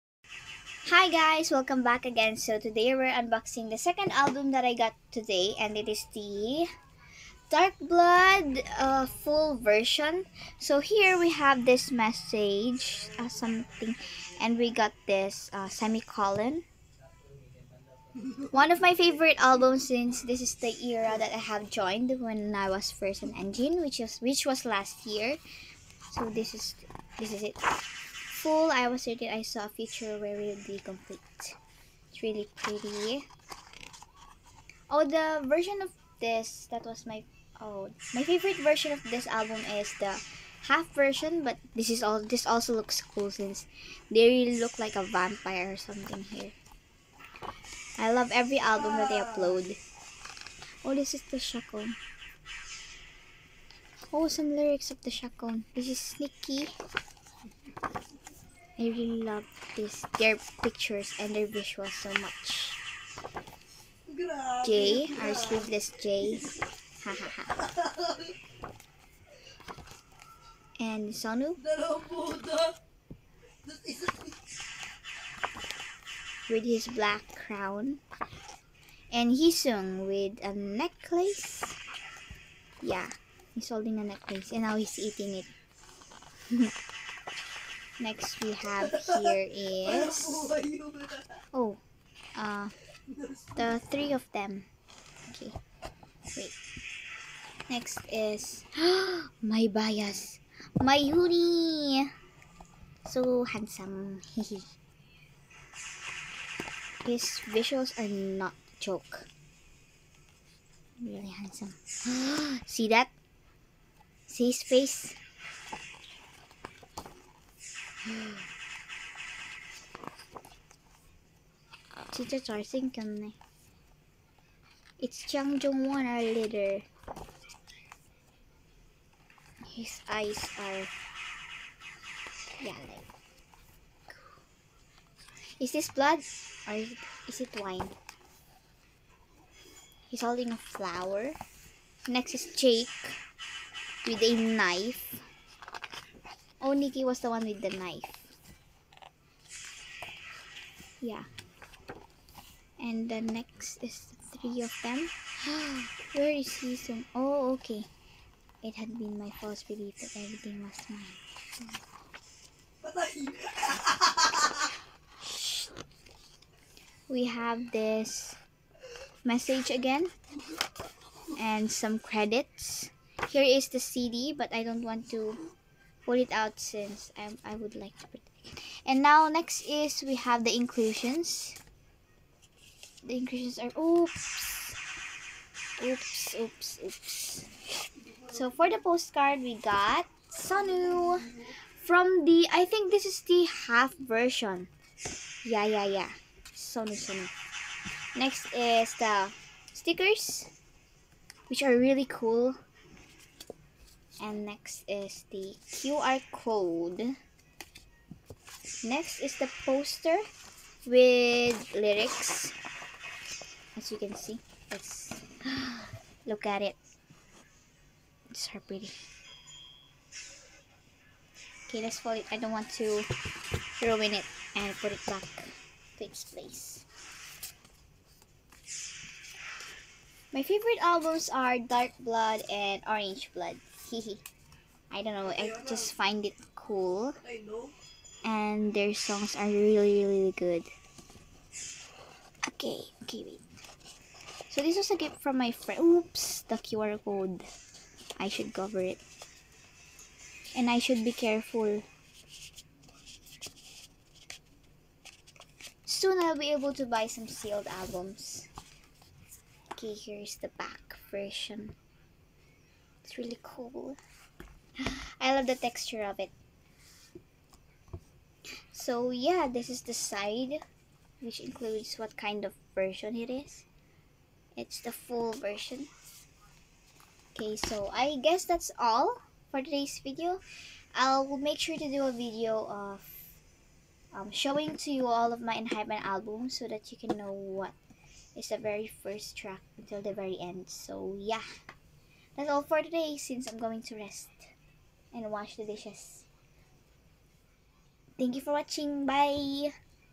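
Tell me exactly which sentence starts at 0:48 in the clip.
I love every album that they upload.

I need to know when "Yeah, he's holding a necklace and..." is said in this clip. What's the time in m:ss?
1:22.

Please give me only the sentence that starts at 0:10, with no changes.
So here we have this message uh, something and we got this uh, semicolon.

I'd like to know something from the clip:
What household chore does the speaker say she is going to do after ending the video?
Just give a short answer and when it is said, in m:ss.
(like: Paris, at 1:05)
Wash the dishes, at 4:55.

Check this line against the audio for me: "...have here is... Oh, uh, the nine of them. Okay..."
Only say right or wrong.
wrong.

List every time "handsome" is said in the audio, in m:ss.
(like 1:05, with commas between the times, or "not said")
1:43, 1:51.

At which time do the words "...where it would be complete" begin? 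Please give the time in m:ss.
0:30.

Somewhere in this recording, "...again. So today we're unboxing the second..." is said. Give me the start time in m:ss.
0:02.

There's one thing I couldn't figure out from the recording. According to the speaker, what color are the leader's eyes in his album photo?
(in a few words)
Yellow.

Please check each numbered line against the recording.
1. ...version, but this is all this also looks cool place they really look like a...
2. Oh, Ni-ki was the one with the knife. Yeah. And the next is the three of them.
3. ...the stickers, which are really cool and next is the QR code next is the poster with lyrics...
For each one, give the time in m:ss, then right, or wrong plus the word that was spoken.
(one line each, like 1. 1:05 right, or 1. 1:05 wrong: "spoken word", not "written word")
1. 0:40 wrong: "since", not "place"
2. 2:26 right
3. 3:18 right.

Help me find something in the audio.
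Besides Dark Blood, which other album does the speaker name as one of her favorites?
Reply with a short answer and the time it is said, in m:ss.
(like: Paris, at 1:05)
Orange Blood, at 3:52.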